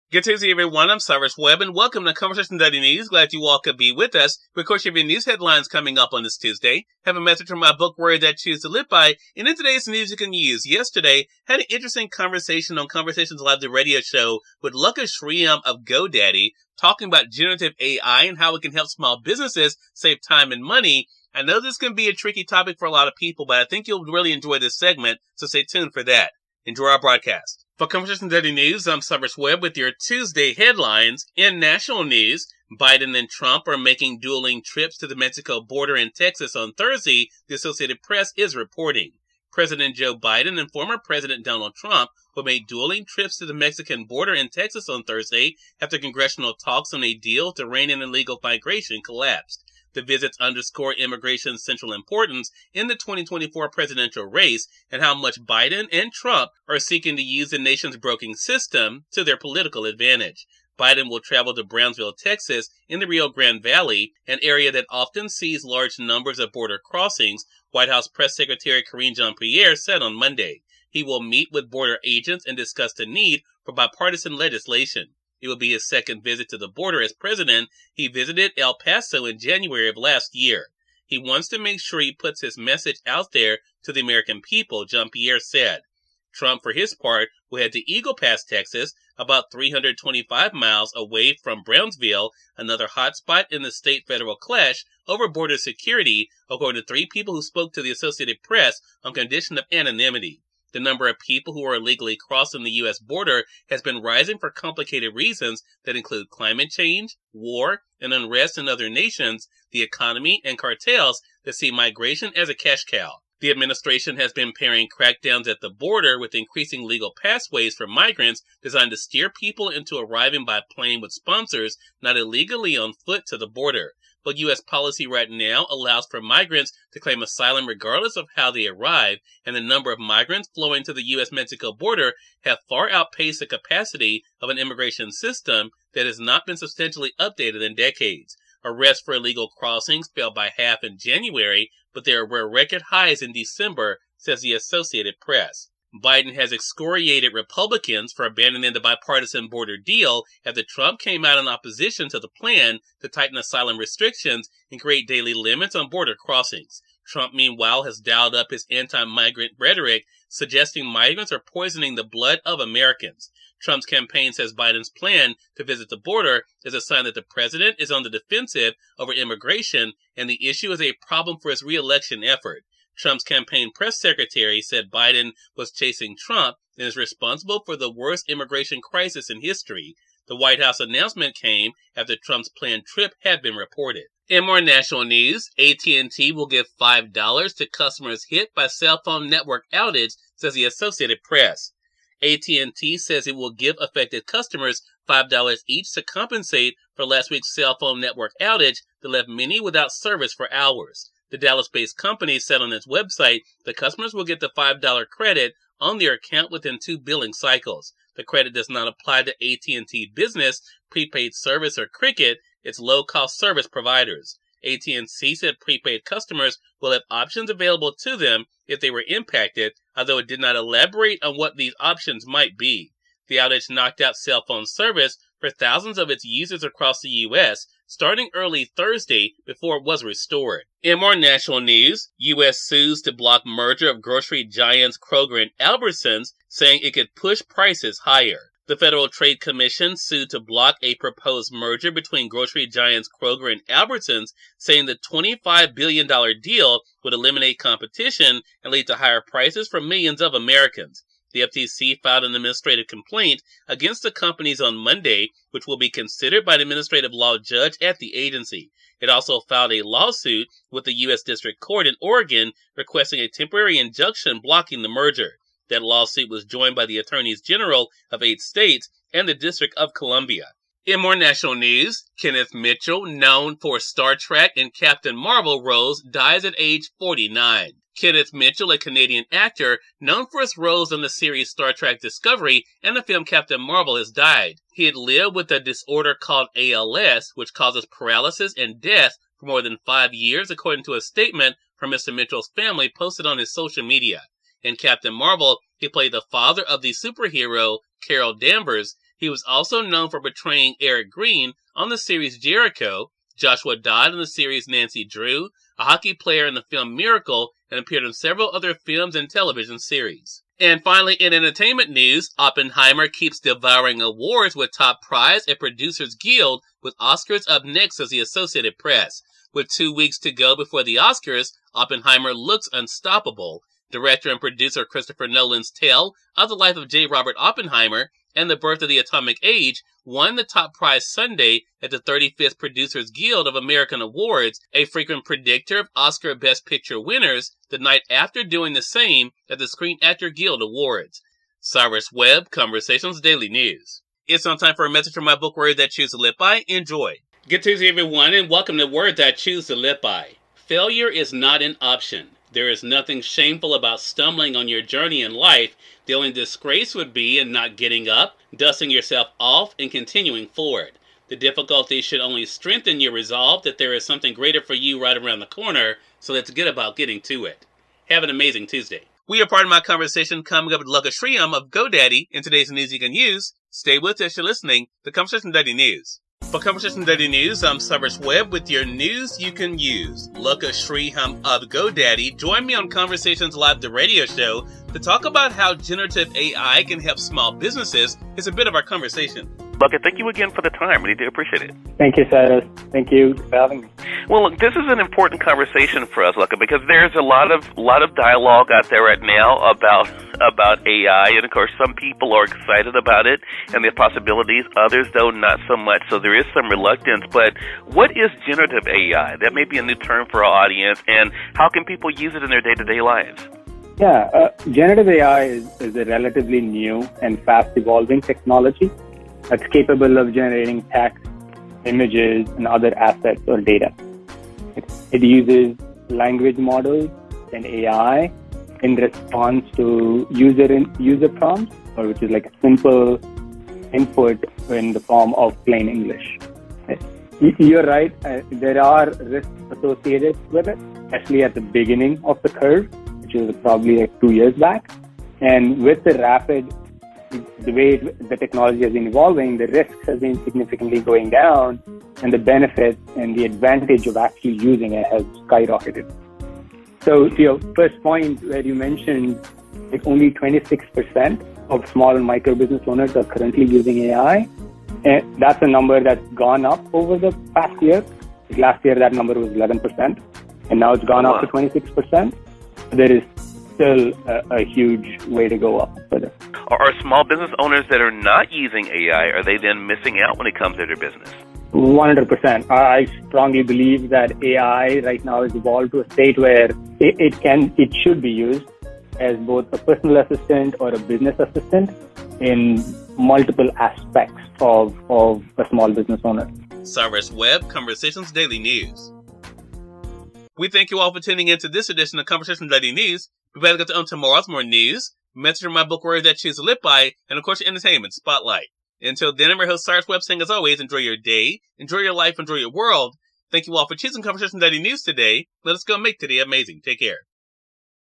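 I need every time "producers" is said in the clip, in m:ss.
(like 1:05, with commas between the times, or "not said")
5:15, 5:24, 5:32.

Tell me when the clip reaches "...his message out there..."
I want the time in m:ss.
1:22.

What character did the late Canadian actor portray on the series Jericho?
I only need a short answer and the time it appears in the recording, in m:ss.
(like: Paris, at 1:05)
Eric Green, at 5:00.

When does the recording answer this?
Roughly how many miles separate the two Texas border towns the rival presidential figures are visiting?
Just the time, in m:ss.
1:29.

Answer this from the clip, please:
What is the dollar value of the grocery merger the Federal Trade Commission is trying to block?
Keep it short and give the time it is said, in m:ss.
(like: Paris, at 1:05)
$25 billion, at 4:05.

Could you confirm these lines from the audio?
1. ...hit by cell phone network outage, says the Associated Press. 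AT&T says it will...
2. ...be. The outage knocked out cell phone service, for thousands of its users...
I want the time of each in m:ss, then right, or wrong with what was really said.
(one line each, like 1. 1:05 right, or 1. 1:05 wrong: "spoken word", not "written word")
1. 3:08 right
2. 3:42 right.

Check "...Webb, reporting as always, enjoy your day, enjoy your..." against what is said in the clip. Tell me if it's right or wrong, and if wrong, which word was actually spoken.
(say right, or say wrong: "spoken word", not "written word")
wrong: "saying", not "reporting".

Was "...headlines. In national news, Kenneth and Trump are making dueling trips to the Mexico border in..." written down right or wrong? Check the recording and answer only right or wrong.
wrong.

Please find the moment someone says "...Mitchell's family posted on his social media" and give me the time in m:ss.
4:52.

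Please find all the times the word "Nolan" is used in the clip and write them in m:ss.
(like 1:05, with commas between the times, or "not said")
5:25.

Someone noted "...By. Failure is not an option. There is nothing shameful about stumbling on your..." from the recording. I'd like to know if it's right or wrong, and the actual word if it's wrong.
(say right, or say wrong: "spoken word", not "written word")
right.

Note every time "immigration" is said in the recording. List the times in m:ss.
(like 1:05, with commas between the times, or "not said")
0:50, 2:14, 2:49, 2:58.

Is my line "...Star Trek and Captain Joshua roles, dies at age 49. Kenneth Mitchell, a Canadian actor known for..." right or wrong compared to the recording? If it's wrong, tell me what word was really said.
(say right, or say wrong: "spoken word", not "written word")
wrong: "Marvel", not "Joshua".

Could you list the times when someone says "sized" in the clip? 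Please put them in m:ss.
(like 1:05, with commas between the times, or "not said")
not said.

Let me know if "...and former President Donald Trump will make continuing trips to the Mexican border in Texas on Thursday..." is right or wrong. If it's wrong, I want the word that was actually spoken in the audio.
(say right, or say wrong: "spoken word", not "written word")
wrong: "dueling", not "continuing".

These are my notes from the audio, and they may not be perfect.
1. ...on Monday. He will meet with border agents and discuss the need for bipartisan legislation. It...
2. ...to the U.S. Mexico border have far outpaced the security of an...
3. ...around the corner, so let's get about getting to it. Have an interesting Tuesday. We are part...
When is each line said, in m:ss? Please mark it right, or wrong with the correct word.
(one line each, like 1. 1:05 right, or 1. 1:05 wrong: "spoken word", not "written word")
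1. 1:10 right
2. 2:10 wrong: "capacity", not "security"
3. 6:05 wrong: "amazing", not "interesting".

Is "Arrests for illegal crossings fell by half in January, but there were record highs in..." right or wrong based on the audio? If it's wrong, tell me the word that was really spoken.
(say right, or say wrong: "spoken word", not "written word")
right.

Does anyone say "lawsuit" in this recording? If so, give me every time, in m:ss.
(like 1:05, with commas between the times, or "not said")
4:19, 4:25.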